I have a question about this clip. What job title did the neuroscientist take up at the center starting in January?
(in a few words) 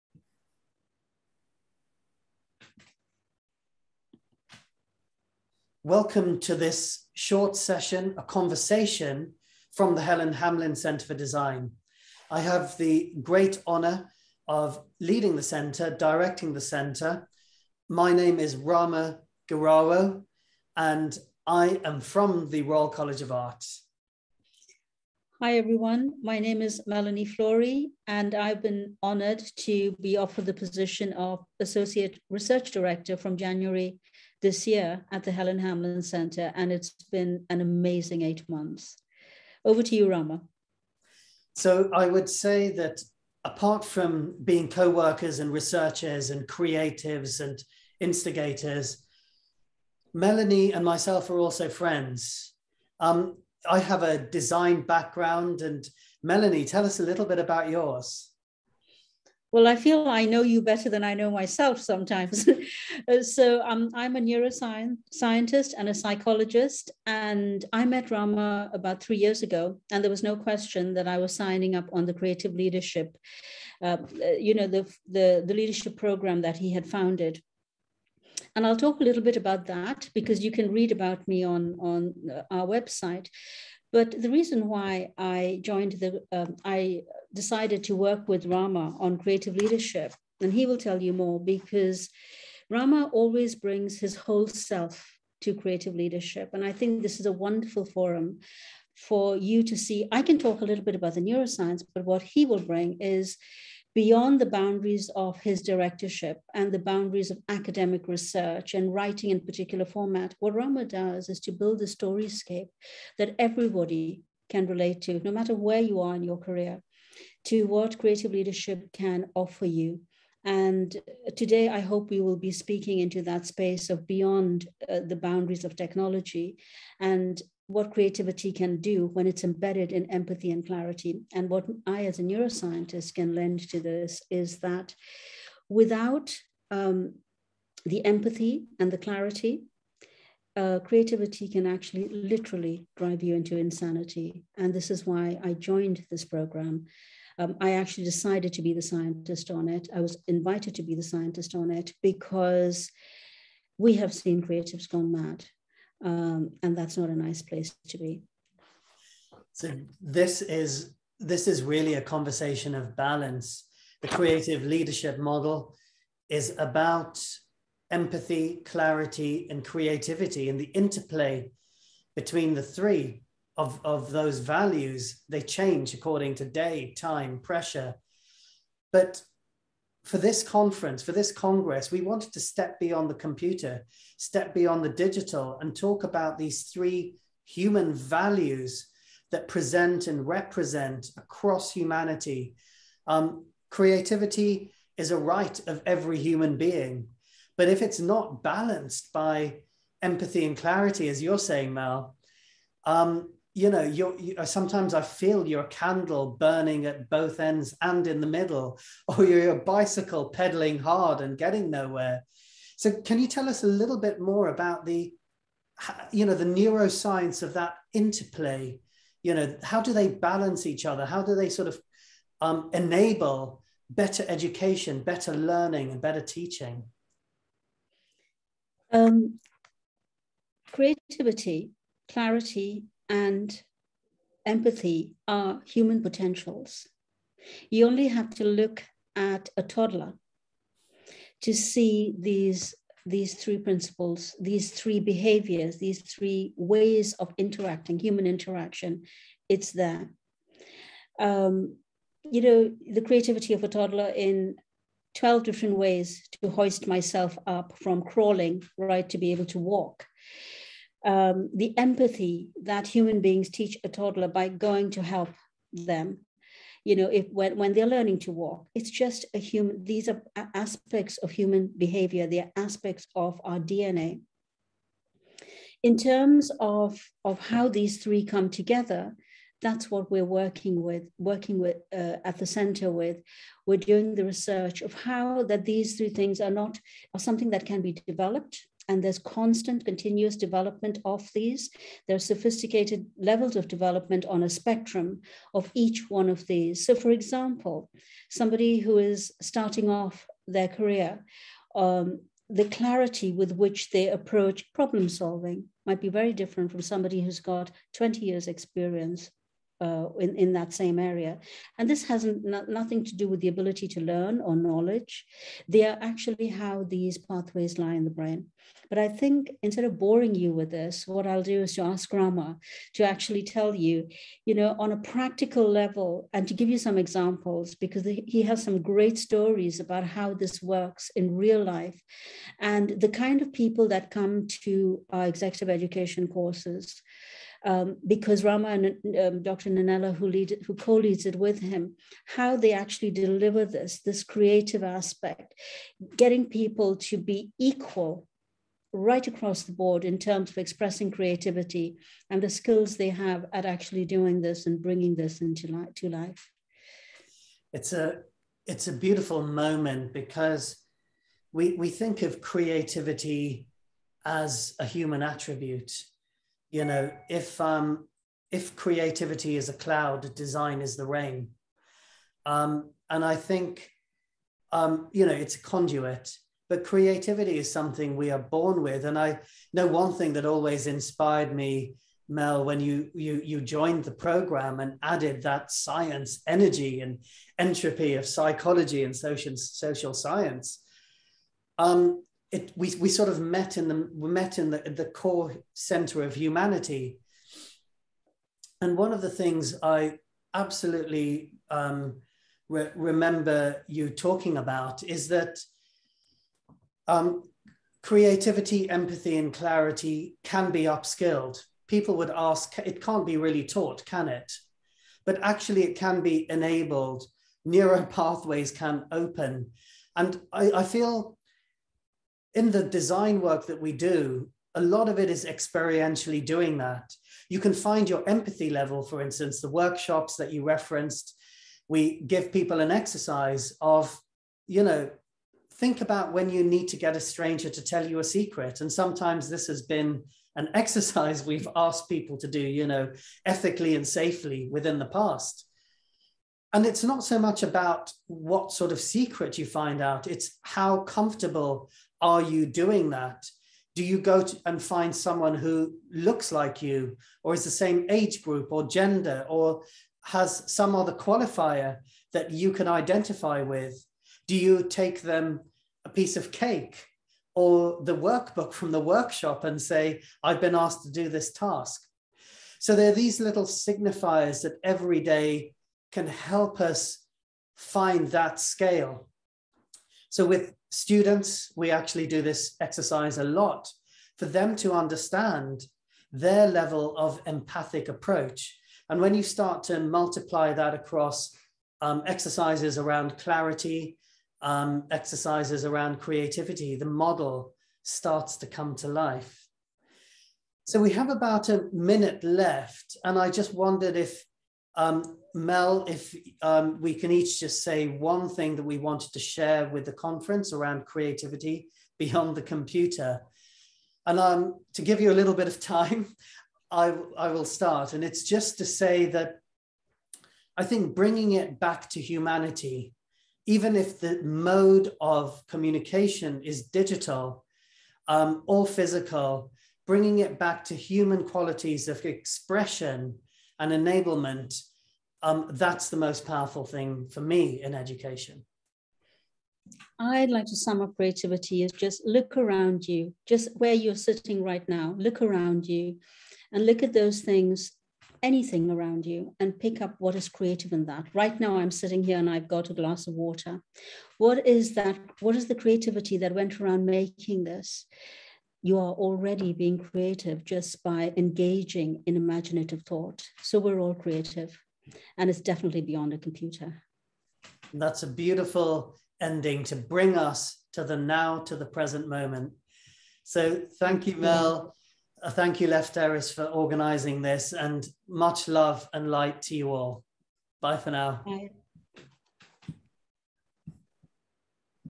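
Associate Research Director.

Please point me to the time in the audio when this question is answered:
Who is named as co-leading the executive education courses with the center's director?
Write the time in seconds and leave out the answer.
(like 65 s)
339 s.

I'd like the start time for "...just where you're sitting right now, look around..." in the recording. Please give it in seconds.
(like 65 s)
543 s.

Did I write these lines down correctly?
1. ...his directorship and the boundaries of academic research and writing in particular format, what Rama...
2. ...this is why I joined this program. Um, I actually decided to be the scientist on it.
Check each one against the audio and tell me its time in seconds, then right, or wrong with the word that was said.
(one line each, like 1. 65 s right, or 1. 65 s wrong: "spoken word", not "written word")
1. 105 s right
2. 144 s right.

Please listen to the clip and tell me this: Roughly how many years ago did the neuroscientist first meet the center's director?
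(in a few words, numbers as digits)
3.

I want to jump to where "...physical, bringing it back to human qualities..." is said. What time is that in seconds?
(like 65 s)
528 s.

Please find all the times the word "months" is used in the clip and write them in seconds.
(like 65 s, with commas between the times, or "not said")
38 s.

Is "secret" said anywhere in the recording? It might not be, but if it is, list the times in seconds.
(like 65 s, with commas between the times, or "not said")
438 s, 449 s.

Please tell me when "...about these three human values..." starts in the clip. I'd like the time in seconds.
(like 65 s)
186 s.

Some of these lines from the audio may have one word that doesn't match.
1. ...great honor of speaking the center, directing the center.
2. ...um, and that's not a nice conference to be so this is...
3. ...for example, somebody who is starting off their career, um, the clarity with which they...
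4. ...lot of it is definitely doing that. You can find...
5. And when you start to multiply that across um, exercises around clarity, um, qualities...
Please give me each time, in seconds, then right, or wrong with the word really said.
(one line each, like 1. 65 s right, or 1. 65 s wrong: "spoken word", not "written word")
1. 13 s wrong: "leading", not "speaking"
2. 156 s wrong: "place", not "conference"
3. 296 s right
4. 424 s wrong: "experientially", not "definitely"
5. 489 s wrong: "exercises", not "qualities".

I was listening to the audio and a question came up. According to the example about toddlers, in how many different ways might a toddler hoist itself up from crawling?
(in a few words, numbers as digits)
12.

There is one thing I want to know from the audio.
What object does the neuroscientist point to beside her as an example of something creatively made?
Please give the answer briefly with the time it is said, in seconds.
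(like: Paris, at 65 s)
a glass of water, at 552 s.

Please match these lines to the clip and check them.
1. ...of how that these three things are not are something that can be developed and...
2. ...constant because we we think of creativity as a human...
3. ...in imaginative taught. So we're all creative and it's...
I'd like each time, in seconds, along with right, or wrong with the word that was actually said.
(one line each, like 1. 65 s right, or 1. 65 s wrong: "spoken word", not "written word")
1. 284 s right
2. 359 s wrong: "moment", not "constant"
3. 562 s wrong: "thought", not "taught".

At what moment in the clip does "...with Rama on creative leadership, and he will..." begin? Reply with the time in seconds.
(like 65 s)
88 s.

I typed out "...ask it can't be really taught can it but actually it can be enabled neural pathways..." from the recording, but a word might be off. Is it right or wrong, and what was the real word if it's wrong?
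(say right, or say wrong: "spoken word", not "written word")
right.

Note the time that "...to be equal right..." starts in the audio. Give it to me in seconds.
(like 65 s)
346 s.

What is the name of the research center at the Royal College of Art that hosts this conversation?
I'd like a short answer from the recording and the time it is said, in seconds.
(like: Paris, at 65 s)
Helen Hamlyn Center for Design, at 10 s.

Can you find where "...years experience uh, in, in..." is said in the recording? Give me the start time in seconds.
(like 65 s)
308 s.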